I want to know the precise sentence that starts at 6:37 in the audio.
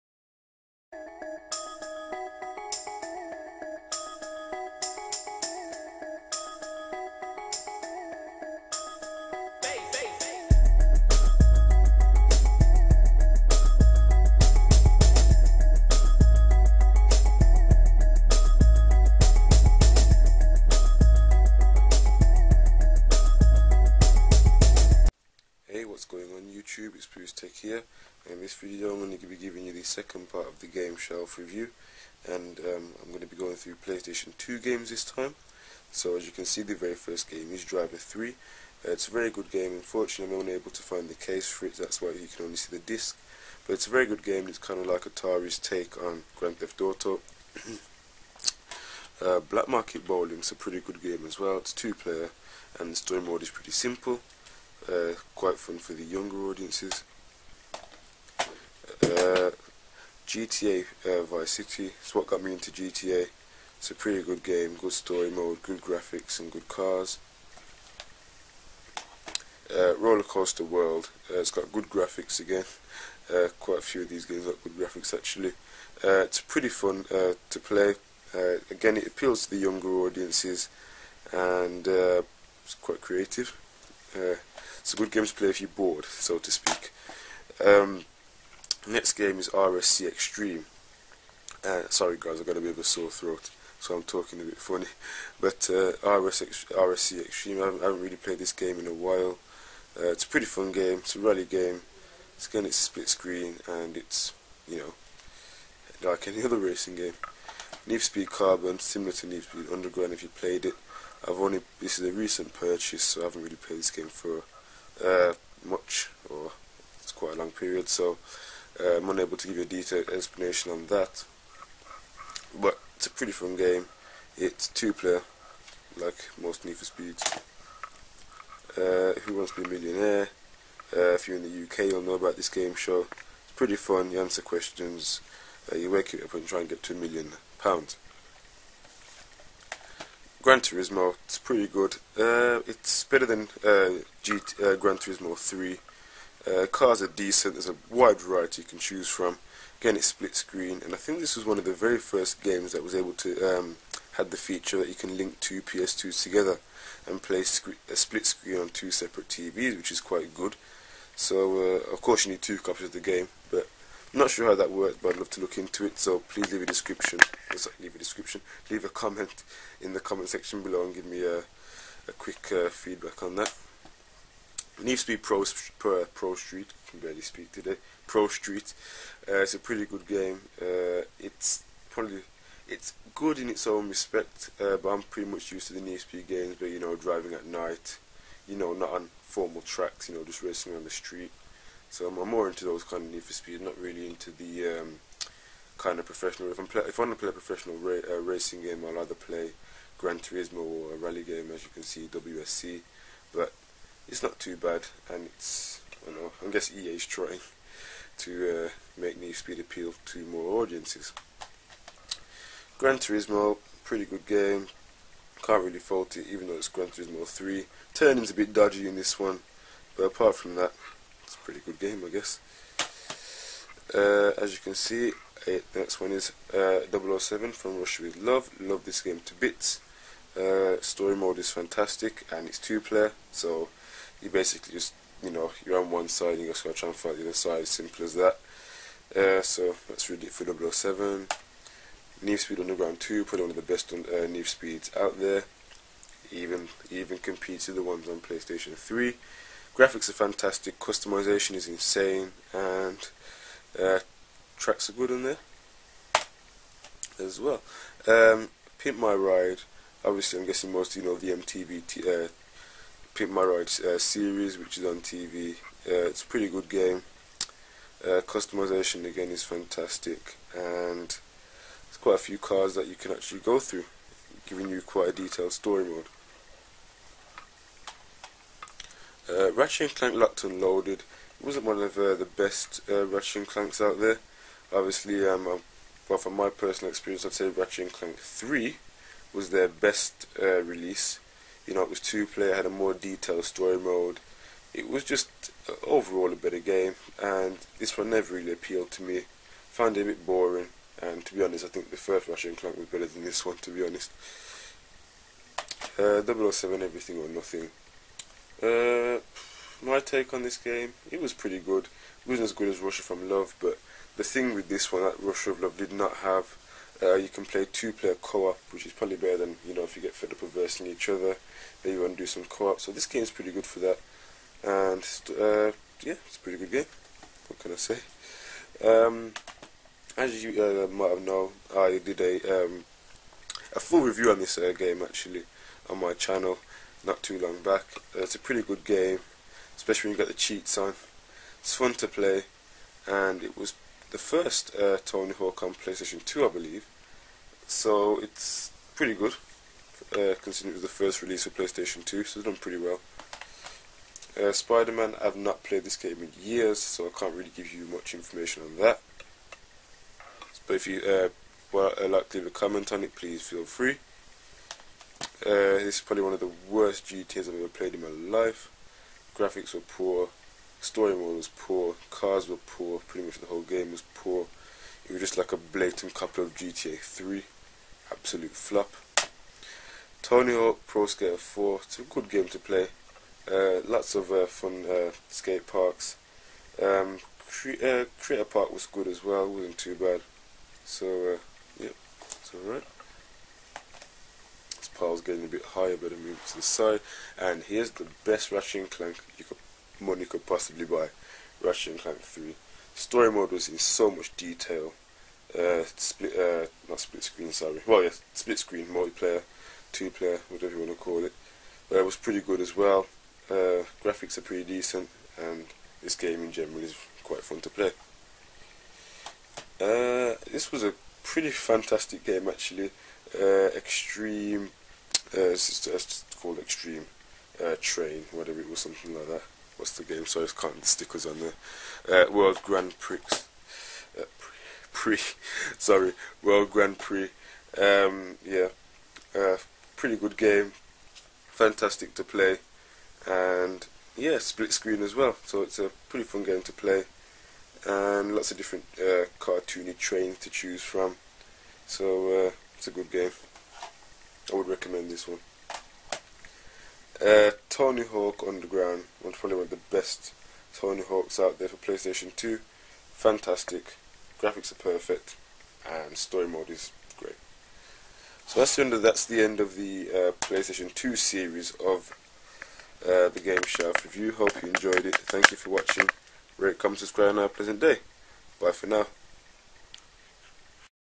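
And here's the best Ratchet and Clank you could money could possibly buy Ratchet and Clank 3.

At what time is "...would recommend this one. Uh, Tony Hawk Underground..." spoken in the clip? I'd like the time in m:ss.
7:34.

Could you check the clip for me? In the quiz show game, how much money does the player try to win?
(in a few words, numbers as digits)
two million pounds.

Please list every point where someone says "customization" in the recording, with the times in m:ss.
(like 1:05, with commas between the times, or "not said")
4:10, 4:28.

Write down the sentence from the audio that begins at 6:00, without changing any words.
But if you uh, well, uh, like to leave a comment on it, please feel free.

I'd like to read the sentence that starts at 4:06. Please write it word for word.
Even even competes with the ones on PlayStation 3.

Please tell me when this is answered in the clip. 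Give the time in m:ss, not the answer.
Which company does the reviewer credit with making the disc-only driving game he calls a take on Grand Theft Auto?
0:45.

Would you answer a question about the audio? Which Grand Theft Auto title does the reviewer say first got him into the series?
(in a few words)
Vice City.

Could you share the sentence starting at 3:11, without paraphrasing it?
So I'm, I'm more into those kind of Need for Speed, not really into the um, kind of professional.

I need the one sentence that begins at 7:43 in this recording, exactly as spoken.
Fantastic, graphics are perfect, and story mode is great.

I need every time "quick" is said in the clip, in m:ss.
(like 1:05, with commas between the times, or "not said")
2:52.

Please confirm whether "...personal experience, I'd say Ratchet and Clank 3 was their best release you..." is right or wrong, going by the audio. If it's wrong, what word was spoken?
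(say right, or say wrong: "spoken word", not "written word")
right.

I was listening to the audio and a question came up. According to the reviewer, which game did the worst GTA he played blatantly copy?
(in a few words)
GTA 3.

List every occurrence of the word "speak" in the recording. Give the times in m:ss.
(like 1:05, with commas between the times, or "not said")
1:26, 2:57.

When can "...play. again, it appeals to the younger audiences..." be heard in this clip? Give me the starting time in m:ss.
1:17.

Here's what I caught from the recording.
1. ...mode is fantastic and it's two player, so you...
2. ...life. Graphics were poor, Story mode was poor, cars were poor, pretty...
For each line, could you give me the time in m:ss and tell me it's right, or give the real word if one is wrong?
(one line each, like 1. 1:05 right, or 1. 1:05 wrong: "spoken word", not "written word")
1. 3:51 right
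2. 6:08 right.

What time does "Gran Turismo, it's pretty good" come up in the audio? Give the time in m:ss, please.
2:20.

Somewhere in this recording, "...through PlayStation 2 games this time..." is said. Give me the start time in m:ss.
0:33.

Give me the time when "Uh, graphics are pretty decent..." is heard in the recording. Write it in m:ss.
6:53.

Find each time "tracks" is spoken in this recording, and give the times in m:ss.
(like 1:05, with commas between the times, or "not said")
3:09, 4:14.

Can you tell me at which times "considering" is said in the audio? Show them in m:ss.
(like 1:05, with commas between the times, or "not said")
5:50.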